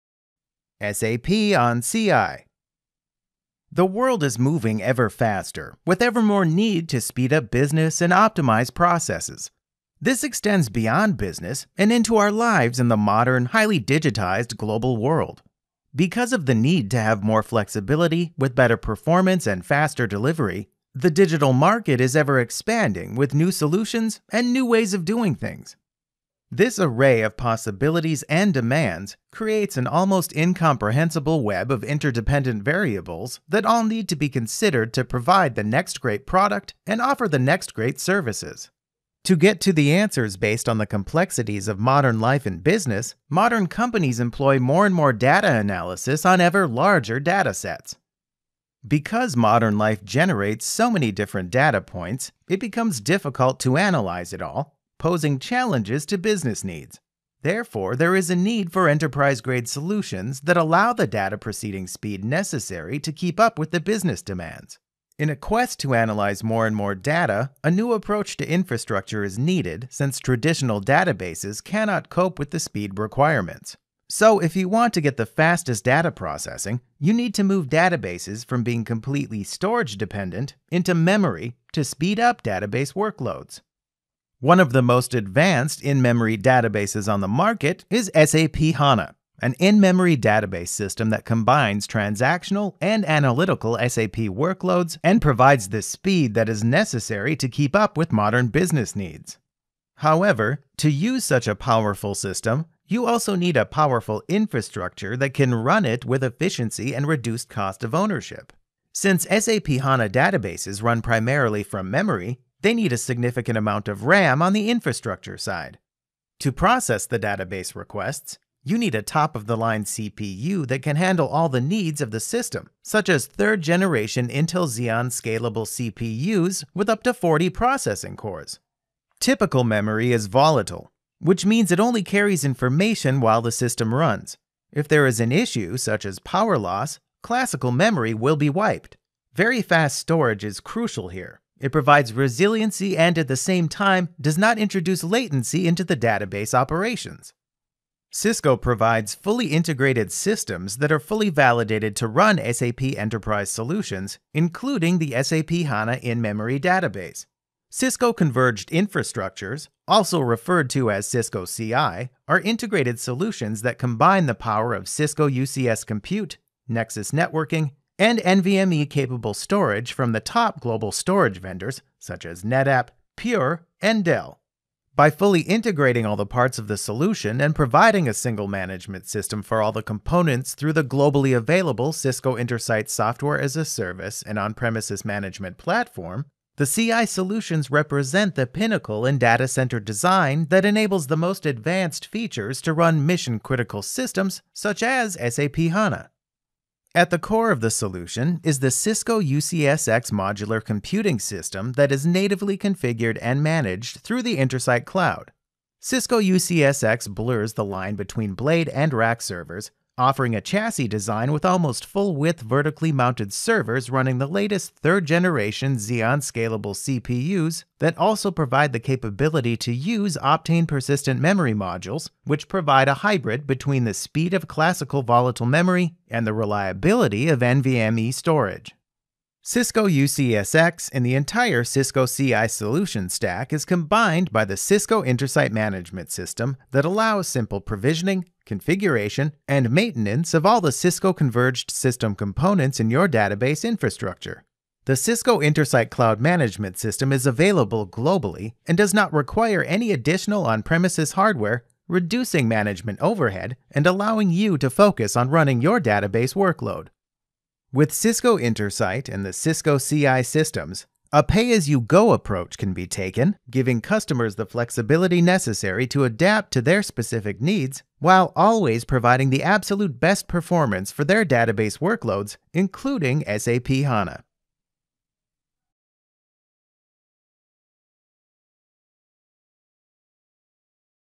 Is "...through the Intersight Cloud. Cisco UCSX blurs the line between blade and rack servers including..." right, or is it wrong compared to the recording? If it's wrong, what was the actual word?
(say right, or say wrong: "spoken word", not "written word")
wrong: "offering", not "including".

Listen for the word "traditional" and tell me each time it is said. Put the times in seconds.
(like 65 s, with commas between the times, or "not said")
70 s.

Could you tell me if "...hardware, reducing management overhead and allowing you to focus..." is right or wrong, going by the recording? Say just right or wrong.
right.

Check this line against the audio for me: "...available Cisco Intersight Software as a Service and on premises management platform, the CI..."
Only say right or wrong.
right.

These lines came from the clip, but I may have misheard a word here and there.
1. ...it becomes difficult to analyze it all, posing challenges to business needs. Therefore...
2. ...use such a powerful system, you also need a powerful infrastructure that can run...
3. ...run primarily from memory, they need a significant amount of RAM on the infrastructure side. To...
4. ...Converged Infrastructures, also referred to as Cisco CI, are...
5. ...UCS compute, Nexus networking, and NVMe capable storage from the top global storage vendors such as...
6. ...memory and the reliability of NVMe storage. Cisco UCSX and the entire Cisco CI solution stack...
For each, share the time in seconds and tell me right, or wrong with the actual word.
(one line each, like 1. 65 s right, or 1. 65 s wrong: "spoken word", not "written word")
1. 52 s right
2. 100 s right
3. 110 s right
4. 158 s right
5. 165 s right
6. 225 s right.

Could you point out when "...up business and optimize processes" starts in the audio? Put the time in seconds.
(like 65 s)
7 s.